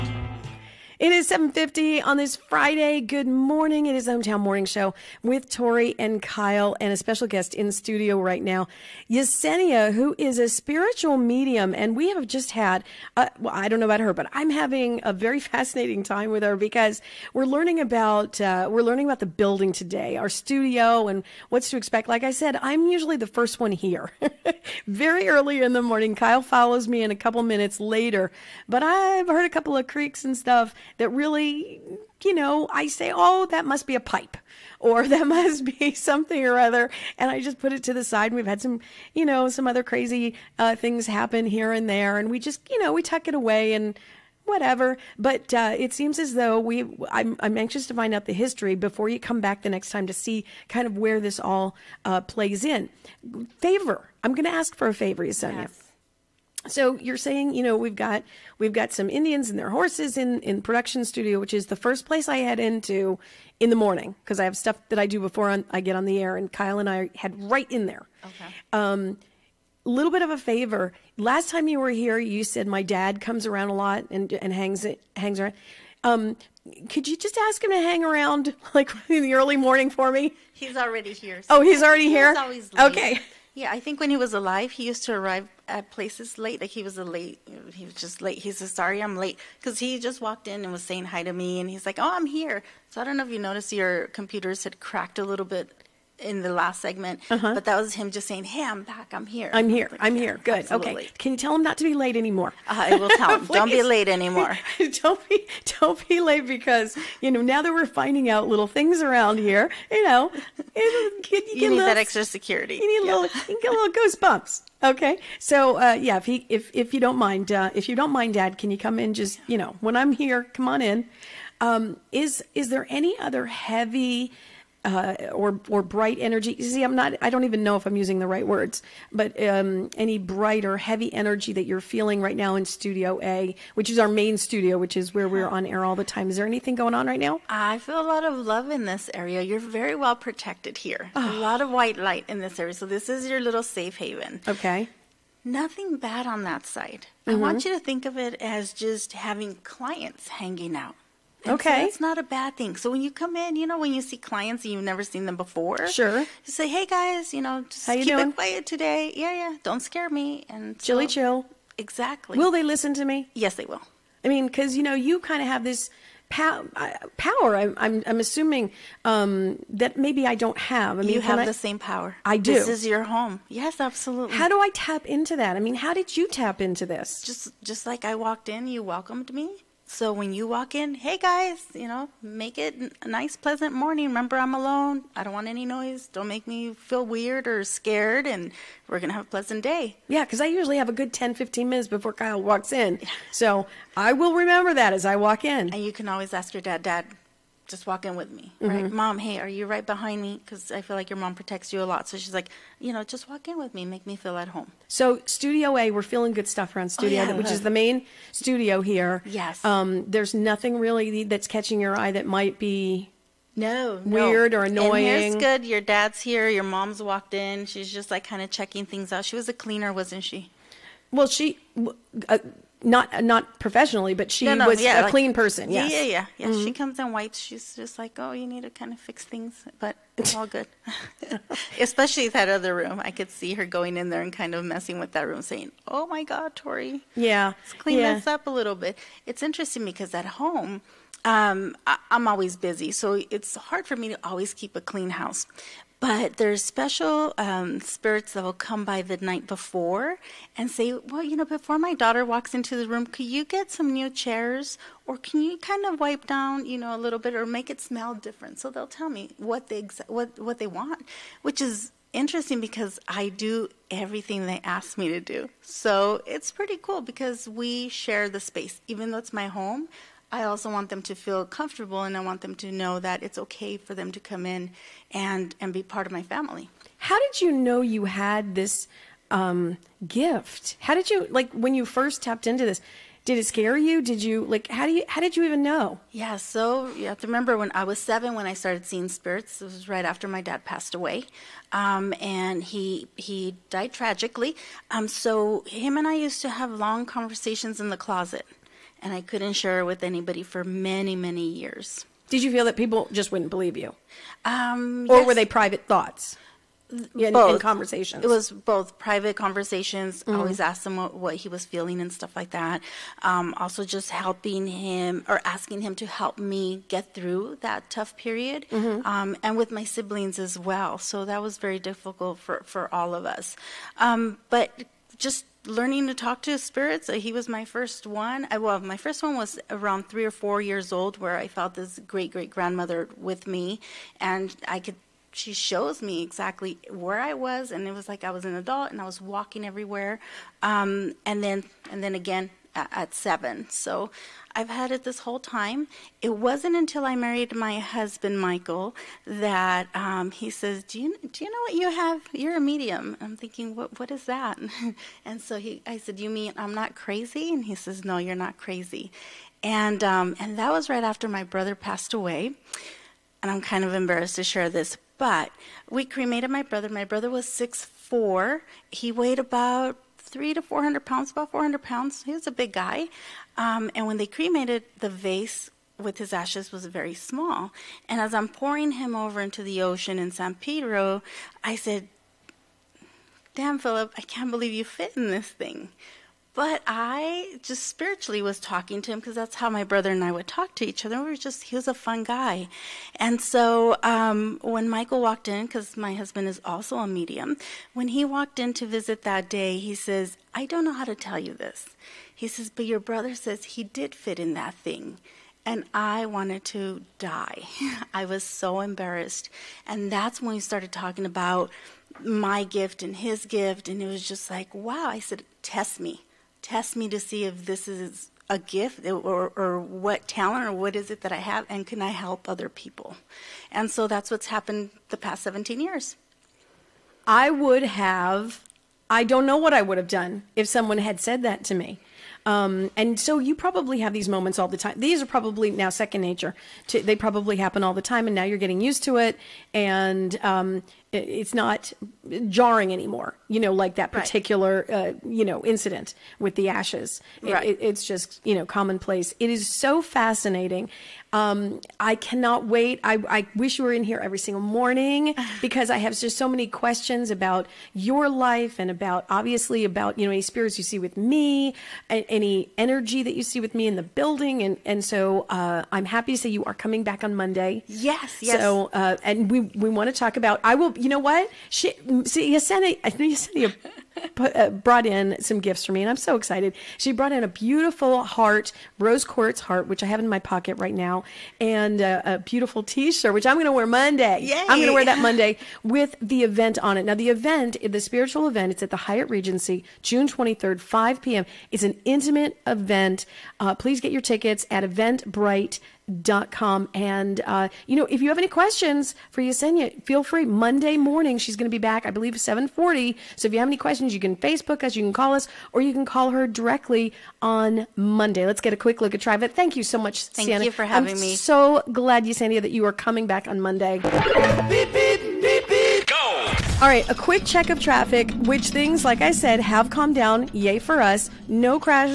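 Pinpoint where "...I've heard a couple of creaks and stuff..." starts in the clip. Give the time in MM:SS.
00:28.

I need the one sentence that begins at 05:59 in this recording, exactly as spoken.
And, um, and that was right after my brother passed away.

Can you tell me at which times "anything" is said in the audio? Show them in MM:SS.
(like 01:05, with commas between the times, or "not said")
02:16.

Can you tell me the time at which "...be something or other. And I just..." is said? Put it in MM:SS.
00:35.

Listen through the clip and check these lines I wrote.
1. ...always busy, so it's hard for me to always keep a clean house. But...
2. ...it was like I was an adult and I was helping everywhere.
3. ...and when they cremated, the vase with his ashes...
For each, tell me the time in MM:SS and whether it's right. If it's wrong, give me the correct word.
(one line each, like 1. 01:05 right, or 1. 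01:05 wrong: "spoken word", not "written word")
1. 04:02 right
2. 05:37 wrong: "walking", not "helping"
3. 06:13 right.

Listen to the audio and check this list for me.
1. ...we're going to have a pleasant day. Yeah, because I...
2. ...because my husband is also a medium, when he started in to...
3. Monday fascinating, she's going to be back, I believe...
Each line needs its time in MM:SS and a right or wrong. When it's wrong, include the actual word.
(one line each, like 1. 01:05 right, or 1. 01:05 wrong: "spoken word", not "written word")
1. 03:08 right
2. 06:35 wrong: "walked", not "started"
3. 08:20 wrong: "morning", not "fascinating".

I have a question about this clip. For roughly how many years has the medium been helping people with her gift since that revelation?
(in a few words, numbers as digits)
17.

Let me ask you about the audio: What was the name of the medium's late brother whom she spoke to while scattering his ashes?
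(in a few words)
Philip.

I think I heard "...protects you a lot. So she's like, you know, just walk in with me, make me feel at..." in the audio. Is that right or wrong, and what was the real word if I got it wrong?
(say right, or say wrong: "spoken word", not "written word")
right.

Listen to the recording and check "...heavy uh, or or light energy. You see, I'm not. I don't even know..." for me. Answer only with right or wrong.
wrong.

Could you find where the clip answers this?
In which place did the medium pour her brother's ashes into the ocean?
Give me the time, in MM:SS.
06:20.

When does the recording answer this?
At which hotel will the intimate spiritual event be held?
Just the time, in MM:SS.
08:08.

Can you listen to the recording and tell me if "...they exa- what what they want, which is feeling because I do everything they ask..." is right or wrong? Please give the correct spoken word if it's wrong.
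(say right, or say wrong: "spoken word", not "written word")
wrong: "interesting", not "feeling".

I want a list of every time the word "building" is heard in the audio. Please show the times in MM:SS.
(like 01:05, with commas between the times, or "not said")
00:19, 07:44.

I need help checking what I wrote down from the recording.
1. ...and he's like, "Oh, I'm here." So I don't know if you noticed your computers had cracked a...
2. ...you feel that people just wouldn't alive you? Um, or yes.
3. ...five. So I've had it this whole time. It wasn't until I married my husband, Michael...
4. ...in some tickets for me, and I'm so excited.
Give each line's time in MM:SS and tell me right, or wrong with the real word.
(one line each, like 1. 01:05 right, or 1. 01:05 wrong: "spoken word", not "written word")
1. 01:31 right
2. 05:02 wrong: "believe", not "alive"
3. 05:43 wrong: "seven", not "five"
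4. 07:55 wrong: "gifts", not "tickets".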